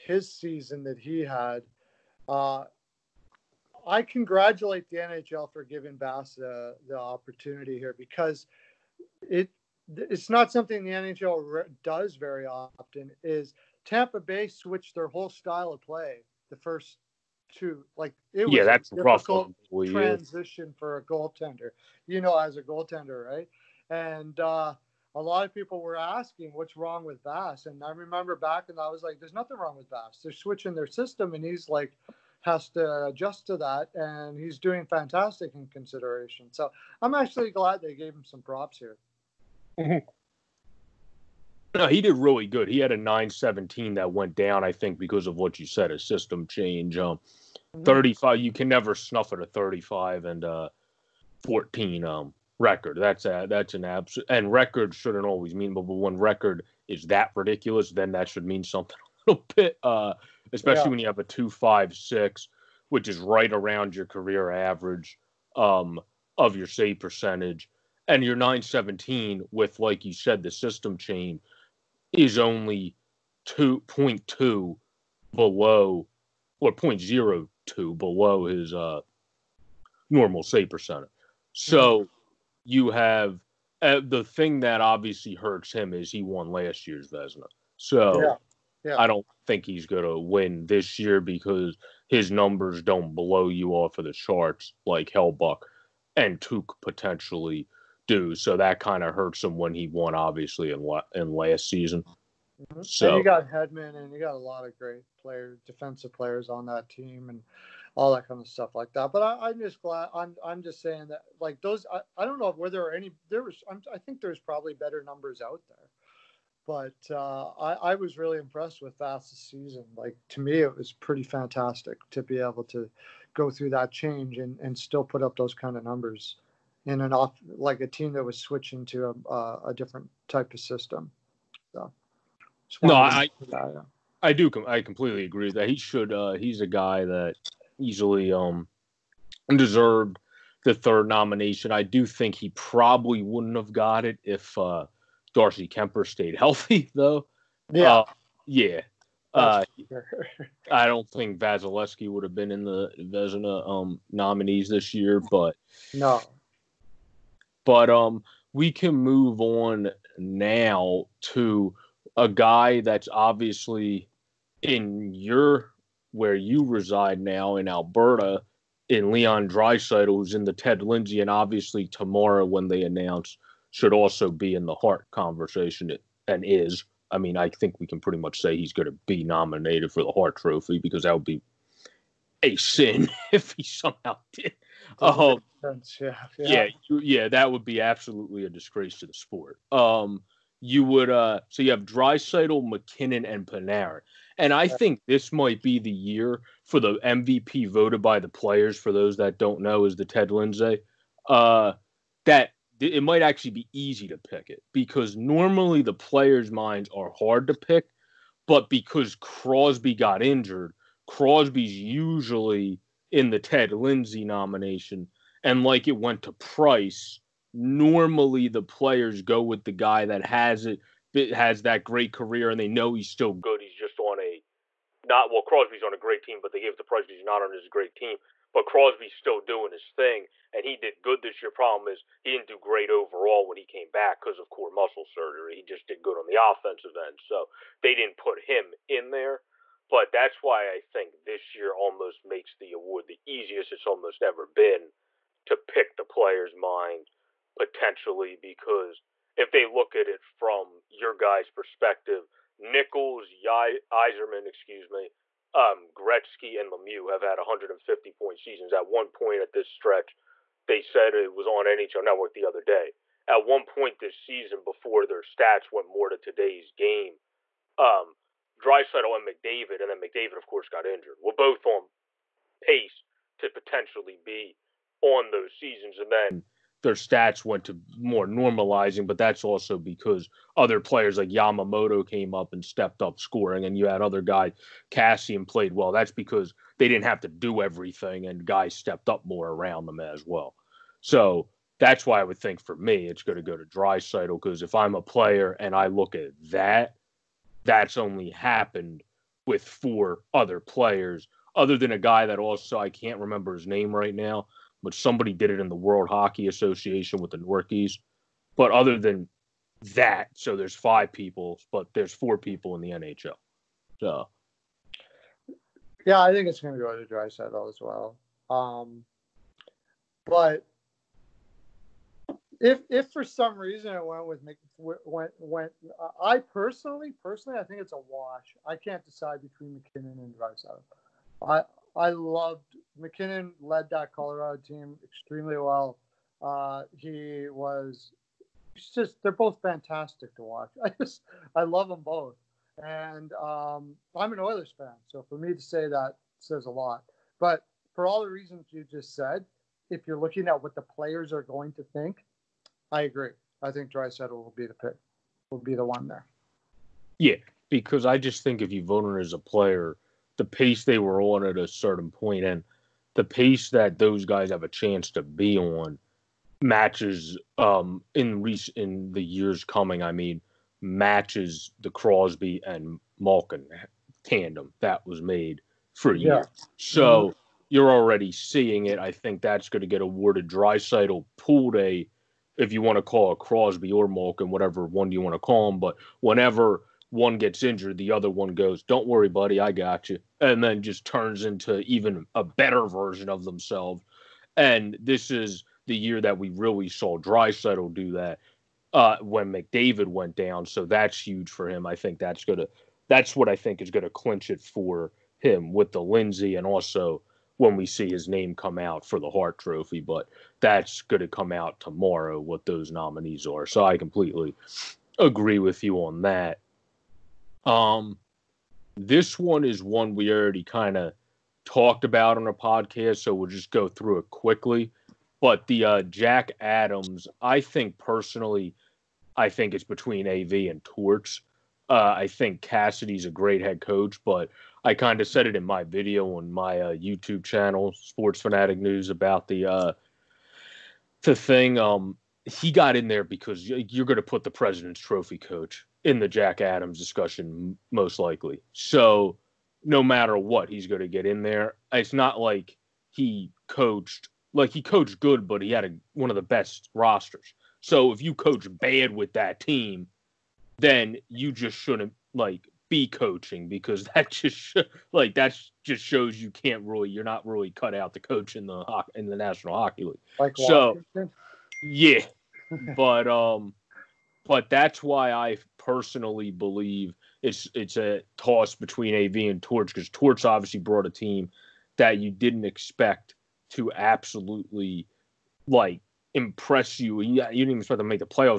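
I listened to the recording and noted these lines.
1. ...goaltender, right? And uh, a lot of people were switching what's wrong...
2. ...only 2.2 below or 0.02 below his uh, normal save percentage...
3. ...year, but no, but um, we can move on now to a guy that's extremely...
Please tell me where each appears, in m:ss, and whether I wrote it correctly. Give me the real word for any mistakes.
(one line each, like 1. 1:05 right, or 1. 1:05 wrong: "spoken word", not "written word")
1. 0:22 wrong: "asking", not "switching"
2. 1:12 right
3. 2:34 wrong: "obviously", not "extremely".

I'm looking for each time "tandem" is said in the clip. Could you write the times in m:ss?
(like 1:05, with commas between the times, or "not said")
6:14.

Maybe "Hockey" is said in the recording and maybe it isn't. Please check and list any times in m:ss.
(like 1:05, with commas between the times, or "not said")
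5:06, 7:49.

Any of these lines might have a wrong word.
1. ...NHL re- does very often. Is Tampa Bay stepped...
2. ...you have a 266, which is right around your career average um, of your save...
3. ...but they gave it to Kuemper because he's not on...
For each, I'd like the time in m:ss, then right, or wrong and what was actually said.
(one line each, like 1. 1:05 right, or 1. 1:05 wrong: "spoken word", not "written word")
1. 0:10 wrong: "switched", not "stepped"
2. 1:00 wrong: "256", not "266"
3. 3:46 wrong: "Price", not "Kuemper".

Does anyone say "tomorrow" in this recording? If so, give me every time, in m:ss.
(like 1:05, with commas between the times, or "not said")
2:51, 6:51.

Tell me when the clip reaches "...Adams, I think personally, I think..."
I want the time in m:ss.
7:06.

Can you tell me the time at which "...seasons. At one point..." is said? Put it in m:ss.
4:18.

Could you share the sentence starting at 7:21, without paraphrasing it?
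Um, he got in there because you're going to put the President's Trophy coach in the Jack Adams discussion, most likely.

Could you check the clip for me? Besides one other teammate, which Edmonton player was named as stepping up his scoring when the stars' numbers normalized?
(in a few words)
Yamamoto.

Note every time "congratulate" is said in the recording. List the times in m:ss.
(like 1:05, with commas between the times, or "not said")
0:04.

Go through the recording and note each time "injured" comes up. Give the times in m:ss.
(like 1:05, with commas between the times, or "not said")
3:30, 4:30, 6:27.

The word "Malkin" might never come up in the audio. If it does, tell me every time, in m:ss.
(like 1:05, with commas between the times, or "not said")
6:13, 6:24.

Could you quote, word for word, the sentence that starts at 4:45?
That's because they didn't have to do everything, and guys stepped up more around them as well.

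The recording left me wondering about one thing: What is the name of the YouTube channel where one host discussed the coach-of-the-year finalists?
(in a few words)
Sports Fanatic News.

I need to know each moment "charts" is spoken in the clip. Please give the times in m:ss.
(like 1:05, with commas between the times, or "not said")
1:34.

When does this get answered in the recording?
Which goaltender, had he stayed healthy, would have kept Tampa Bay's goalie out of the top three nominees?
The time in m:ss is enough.
2:25.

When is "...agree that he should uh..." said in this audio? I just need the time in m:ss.
2:15.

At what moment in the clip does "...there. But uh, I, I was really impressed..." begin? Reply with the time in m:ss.
1:55.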